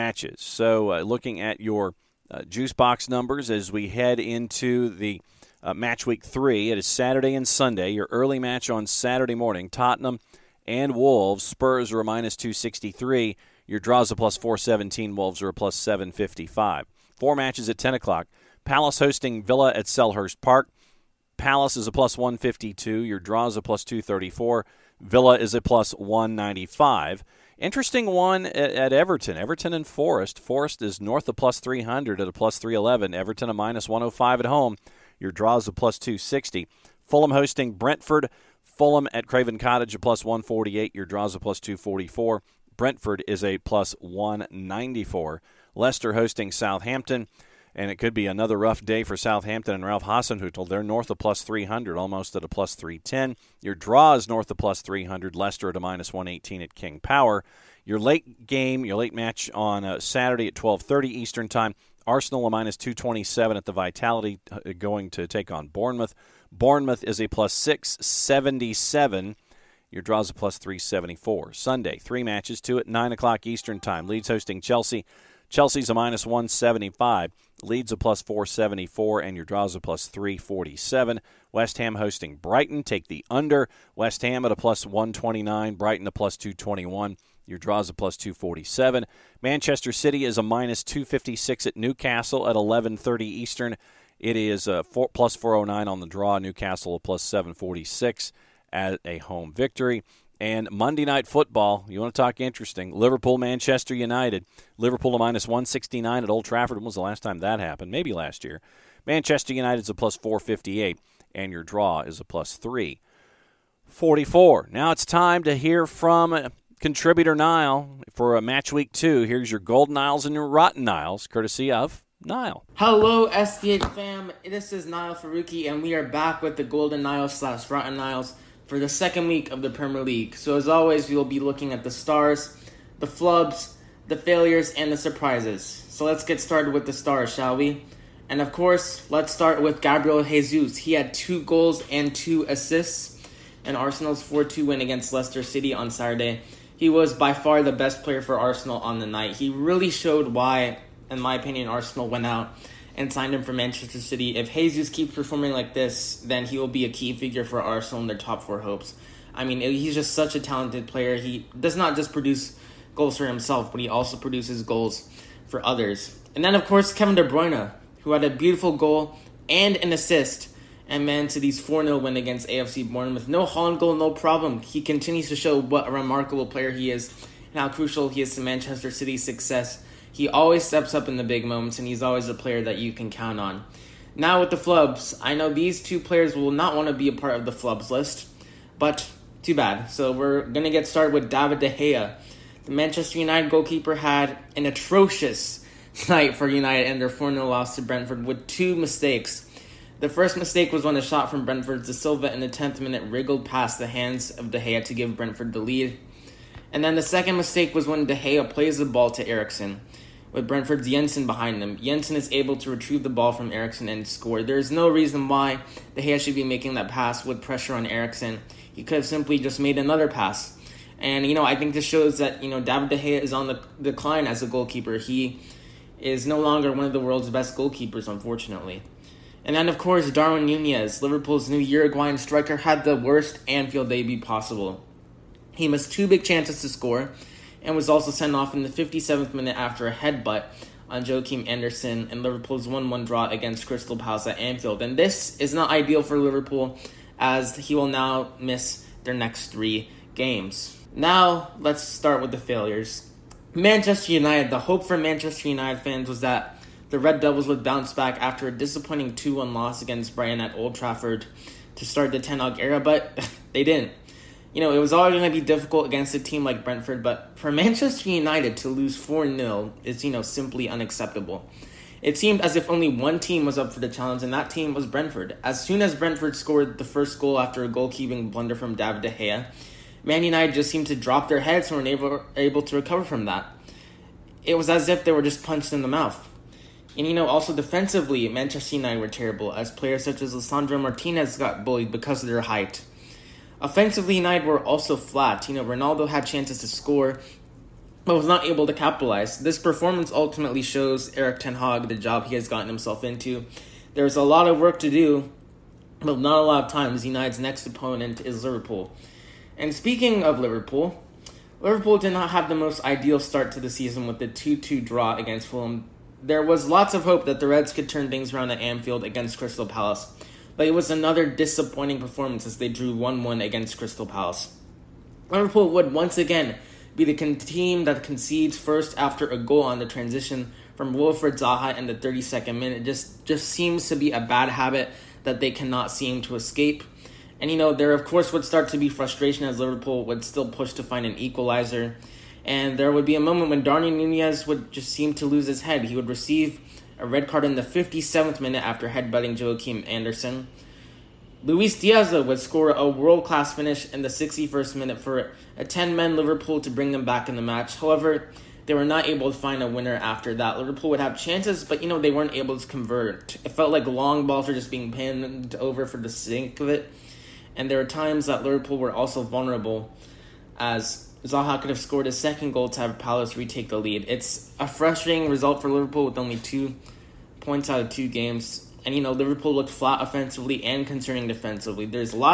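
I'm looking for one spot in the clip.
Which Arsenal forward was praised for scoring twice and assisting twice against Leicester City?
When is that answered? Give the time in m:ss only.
2:19.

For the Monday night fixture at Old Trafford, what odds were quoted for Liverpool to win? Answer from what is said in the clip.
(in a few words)
-169.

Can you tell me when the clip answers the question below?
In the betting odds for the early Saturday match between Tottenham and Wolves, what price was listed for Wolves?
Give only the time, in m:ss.
0:15.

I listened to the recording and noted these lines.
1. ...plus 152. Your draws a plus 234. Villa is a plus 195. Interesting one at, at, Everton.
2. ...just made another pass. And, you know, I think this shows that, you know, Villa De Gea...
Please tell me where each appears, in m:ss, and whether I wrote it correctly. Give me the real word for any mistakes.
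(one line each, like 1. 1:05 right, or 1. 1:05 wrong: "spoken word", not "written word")
1. 0:21 right
2. 3:39 wrong: "David", not "Villa".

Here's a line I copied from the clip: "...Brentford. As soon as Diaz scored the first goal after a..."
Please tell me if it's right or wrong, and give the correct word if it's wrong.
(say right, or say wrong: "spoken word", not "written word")
wrong: "Brentford", not "Diaz".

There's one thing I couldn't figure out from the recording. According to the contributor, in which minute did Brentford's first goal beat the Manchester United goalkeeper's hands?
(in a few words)
10th minute.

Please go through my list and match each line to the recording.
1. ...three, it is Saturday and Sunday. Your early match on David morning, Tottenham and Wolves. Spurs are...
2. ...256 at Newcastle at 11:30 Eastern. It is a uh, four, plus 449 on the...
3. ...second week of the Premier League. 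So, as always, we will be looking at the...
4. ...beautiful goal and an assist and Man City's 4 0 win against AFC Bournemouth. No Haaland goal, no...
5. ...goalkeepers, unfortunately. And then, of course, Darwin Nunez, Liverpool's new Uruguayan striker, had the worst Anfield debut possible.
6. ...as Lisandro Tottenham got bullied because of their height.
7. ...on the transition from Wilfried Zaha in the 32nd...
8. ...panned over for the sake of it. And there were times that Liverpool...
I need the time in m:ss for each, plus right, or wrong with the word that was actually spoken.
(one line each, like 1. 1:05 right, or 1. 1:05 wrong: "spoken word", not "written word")
1. 0:06 wrong: "Saturday", not "David"
2. 1:30 wrong: "409", not "449"
3. 2:08 right
4. 2:48 right
5. 3:47 right
6. 4:50 wrong: "Martinez", not "Tottenham"
7. 5:29 right
8. 6:04 right.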